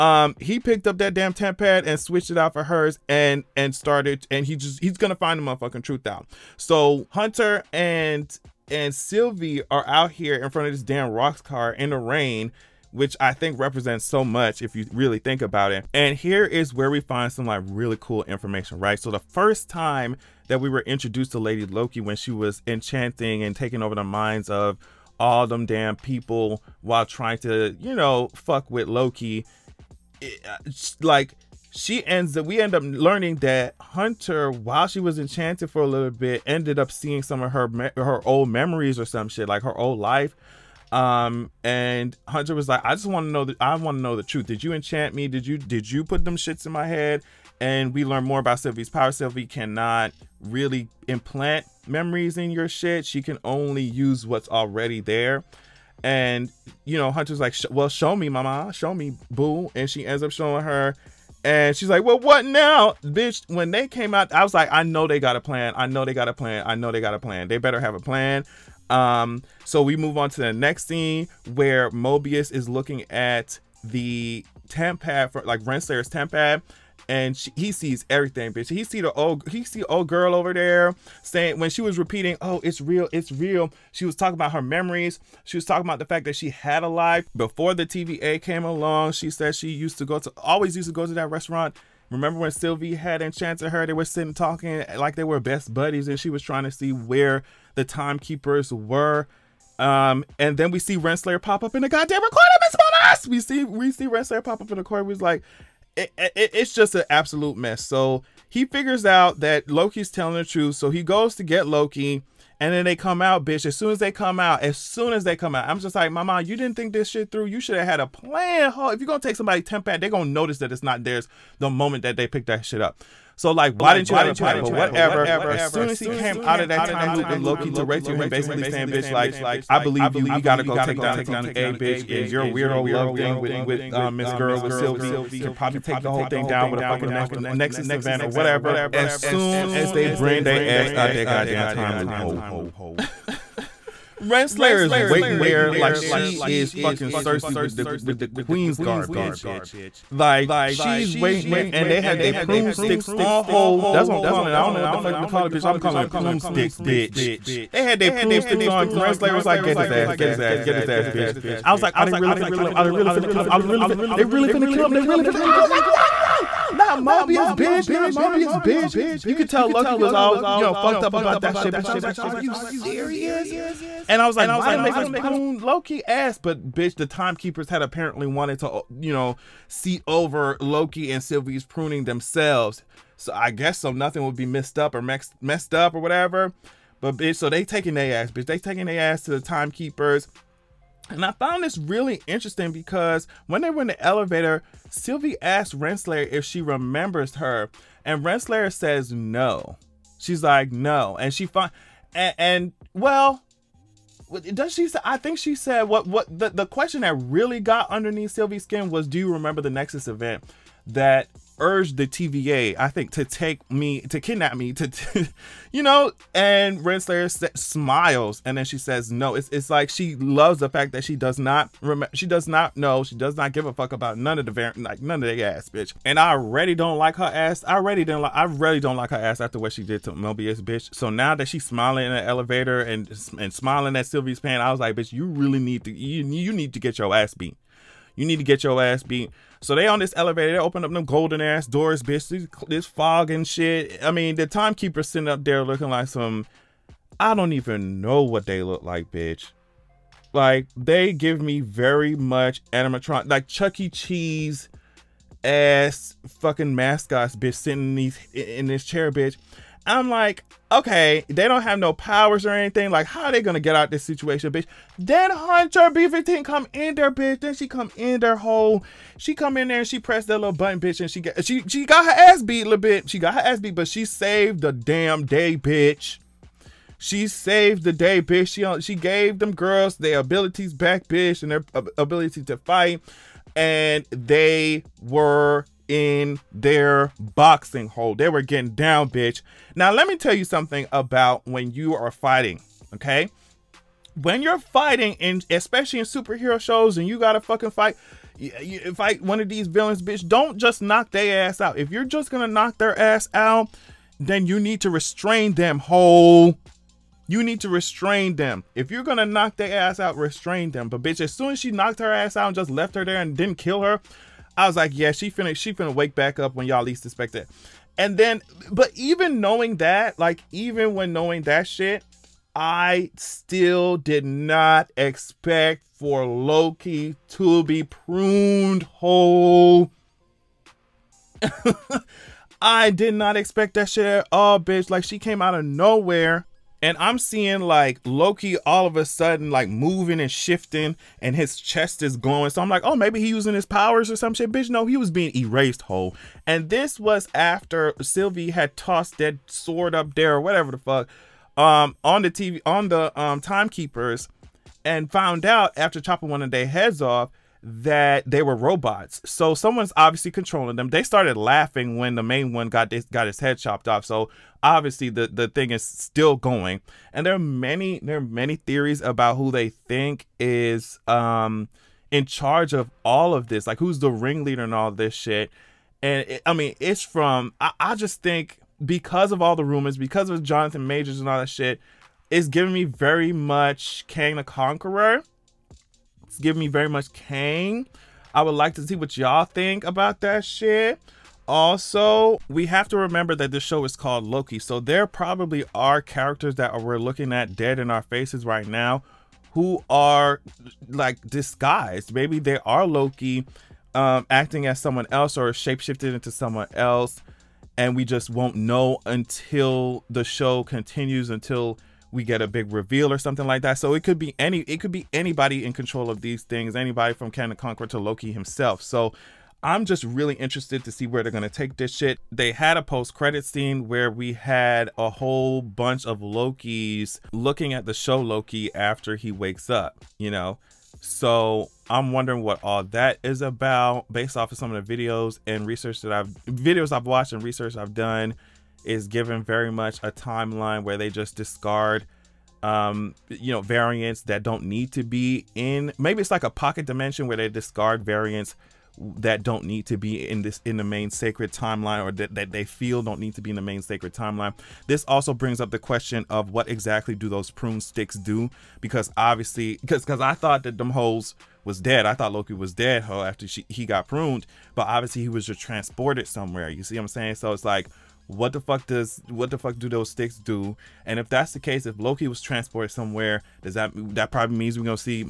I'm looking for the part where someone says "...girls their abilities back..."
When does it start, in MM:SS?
04:39.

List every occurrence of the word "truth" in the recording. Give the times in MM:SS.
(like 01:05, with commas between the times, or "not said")
00:05, 00:44, 01:50.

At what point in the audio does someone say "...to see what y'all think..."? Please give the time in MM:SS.
06:28.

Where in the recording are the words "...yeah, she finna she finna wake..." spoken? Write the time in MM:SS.
05:14.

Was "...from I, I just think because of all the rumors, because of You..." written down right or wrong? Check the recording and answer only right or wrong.
wrong.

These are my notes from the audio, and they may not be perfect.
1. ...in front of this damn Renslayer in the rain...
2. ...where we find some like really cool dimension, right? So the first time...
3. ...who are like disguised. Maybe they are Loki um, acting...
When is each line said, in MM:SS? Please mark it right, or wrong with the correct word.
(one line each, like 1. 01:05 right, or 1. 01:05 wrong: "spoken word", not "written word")
1. 00:10 wrong: "Roxxcart", not "Renslayer"
2. 00:16 wrong: "information", not "dimension"
3. 06:39 right.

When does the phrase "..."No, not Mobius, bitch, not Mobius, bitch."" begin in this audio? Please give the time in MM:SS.
02:46.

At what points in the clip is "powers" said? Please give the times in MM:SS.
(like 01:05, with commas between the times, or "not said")
00:48, 04:21, 05:43.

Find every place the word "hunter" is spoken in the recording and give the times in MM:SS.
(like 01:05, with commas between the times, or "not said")
00:07, 00:33, 00:42, 00:57, 04:25.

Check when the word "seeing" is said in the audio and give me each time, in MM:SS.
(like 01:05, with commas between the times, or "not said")
00:36, 05:37.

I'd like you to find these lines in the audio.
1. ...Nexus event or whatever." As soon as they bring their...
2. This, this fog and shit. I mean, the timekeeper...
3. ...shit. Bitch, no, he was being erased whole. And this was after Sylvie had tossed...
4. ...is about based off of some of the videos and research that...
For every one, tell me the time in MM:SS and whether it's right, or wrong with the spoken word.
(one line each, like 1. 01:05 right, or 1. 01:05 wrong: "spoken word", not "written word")
1. 02:17 right
2. 04:02 right
3. 05:44 right
4. 07:13 right.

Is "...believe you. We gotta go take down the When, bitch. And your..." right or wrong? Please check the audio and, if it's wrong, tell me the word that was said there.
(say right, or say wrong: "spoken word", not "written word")
wrong: "TVA", not "When".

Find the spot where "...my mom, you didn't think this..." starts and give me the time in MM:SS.
01:56.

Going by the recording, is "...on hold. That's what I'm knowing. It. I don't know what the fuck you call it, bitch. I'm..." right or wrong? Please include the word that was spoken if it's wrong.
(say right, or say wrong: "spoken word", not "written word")
wrong: "calling", not "knowing".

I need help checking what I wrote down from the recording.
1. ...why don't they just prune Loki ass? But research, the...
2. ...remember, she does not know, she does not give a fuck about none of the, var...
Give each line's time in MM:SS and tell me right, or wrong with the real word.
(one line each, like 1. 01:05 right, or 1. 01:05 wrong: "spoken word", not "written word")
1. 02:54 wrong: "bitch", not "research"
2. 03:41 right.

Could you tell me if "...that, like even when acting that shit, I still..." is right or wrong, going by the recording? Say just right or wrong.
wrong.